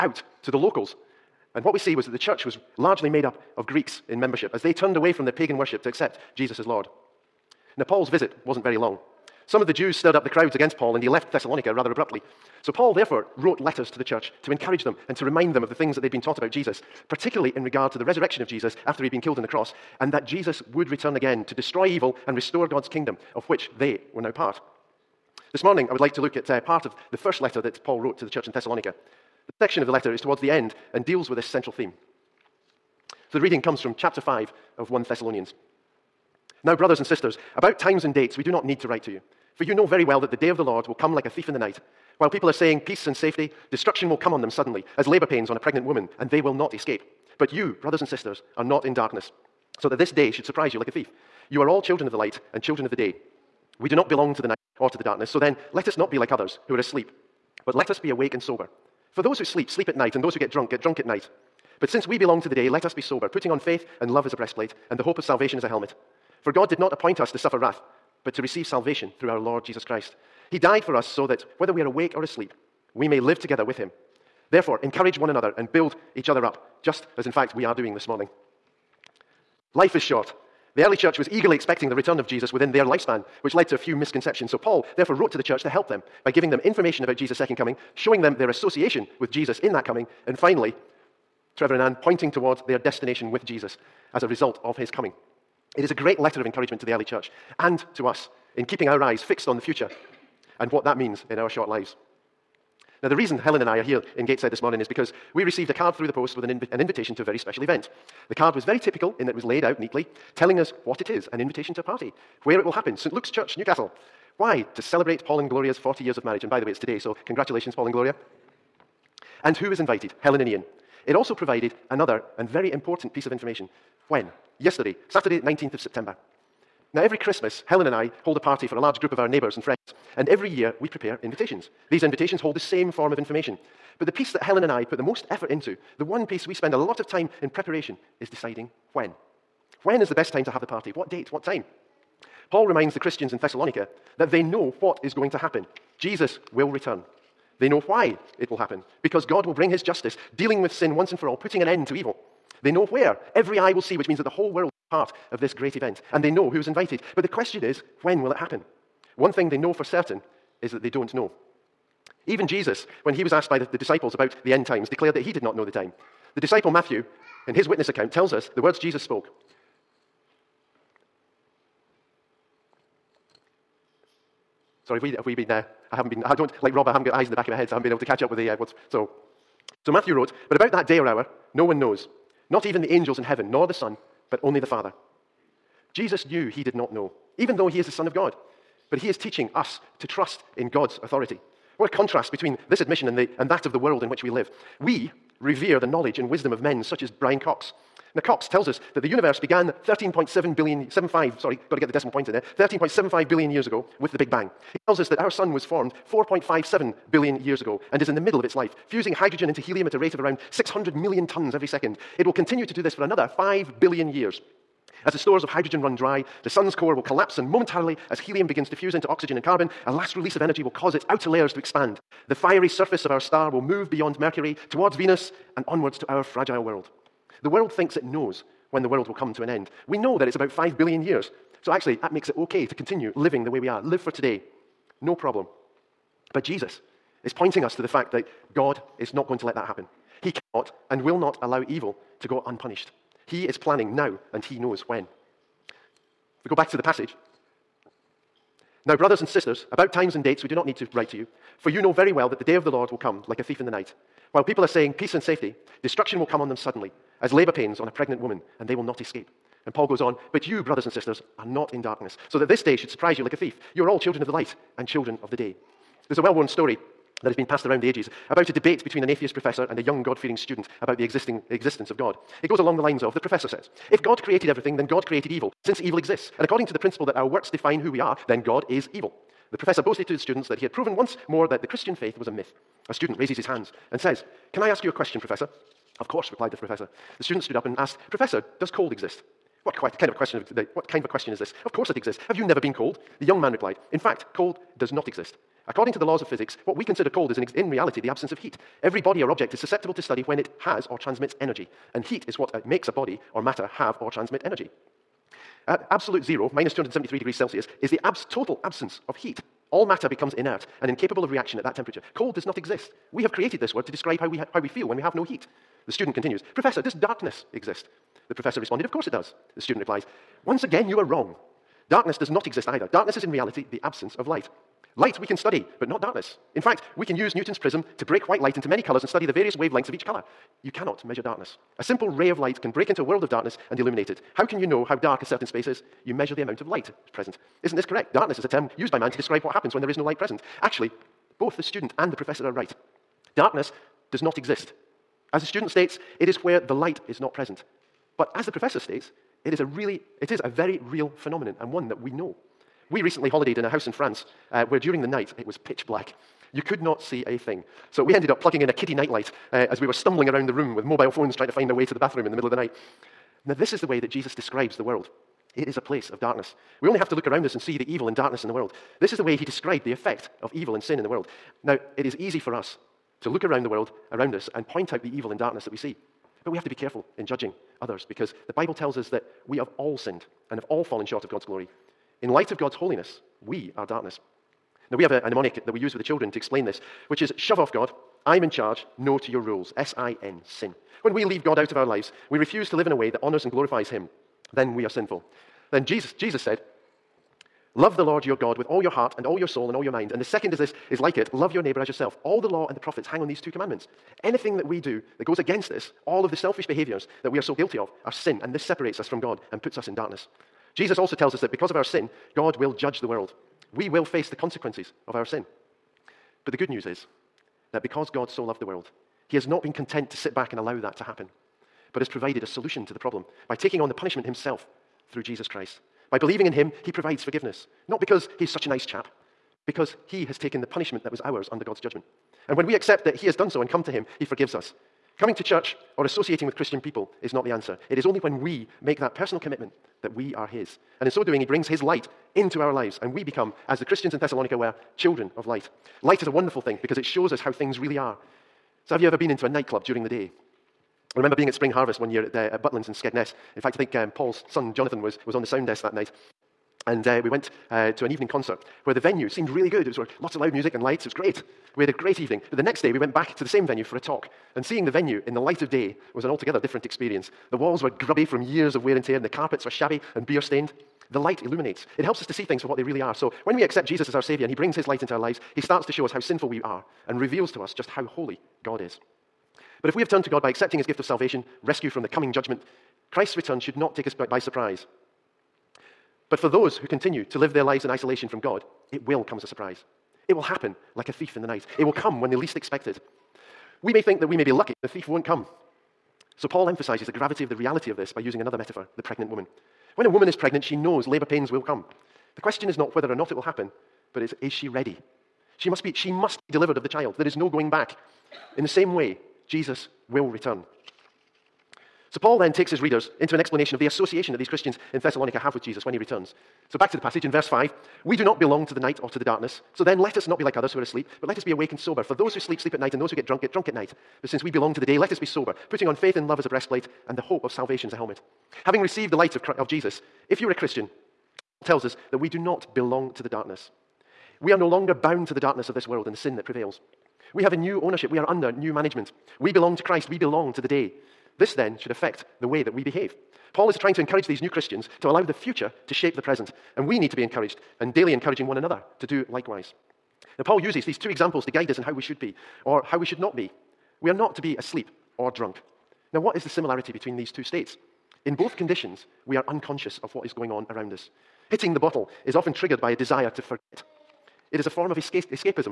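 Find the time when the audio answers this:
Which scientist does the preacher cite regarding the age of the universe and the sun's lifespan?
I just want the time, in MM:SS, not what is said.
03:17.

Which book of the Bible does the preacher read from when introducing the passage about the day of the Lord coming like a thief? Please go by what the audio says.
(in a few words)
1 Thessalonians.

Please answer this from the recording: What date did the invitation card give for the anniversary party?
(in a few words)
Saturday, 19th of September.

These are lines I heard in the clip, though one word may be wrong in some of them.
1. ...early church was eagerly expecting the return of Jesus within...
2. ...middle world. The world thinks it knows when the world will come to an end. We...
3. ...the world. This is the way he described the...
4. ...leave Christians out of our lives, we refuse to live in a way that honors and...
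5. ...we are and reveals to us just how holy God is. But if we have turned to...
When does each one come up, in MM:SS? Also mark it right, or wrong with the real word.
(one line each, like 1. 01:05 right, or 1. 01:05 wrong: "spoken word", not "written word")
1. 01:20 right
2. 03:46 wrong: "fragile", not "middle"
3. 06:08 right
4. 06:31 wrong: "God", not "Christians"
5. 07:56 right.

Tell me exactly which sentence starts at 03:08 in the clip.
But he is teaching us to trust in God's authority.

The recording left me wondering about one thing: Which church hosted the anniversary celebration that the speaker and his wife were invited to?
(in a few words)
St. Luke's Church, Newcastle.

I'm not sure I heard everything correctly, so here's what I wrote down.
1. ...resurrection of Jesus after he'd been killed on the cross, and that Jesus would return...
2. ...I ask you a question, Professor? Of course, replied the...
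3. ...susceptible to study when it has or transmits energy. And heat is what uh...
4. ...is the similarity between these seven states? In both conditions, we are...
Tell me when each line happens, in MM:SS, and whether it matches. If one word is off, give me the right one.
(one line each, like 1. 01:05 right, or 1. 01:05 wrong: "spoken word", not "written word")
1. 00:18 right
2. 04:44 right
3. 04:59 right
4. 09:16 wrong: "two", not "seven".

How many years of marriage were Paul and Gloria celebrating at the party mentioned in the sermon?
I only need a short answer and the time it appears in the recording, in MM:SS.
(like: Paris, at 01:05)
40, at 01:55.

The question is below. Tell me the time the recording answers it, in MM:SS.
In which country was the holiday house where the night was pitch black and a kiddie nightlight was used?
05:53.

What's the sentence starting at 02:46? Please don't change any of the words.
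The disciple Matthew in his witness account, tells us the words Jesus spoke.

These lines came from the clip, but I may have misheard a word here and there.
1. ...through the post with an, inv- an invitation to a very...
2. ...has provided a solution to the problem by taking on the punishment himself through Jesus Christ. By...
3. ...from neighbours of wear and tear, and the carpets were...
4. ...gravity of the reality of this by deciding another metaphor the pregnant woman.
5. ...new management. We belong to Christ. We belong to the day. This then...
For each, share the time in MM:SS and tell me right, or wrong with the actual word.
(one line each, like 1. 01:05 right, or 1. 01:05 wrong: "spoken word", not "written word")
1. 01:45 right
2. 07:02 right
3. 07:48 wrong: "years", not "neighbours"
4. 08:17 wrong: "using", not "deciding"
5. 08:58 right.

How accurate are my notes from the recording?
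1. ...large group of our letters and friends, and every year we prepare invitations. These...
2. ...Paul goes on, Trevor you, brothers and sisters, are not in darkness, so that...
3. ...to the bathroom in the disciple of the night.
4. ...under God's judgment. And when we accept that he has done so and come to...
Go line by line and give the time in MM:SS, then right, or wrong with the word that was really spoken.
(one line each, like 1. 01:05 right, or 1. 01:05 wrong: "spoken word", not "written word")
1. 02:08 wrong: "neighbours", not "letters"
2. 04:19 wrong: "But", not "Trevor"
3. 06:01 wrong: "middle", not "disciple"
4. 07:11 right.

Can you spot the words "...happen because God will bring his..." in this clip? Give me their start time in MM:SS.
02:28.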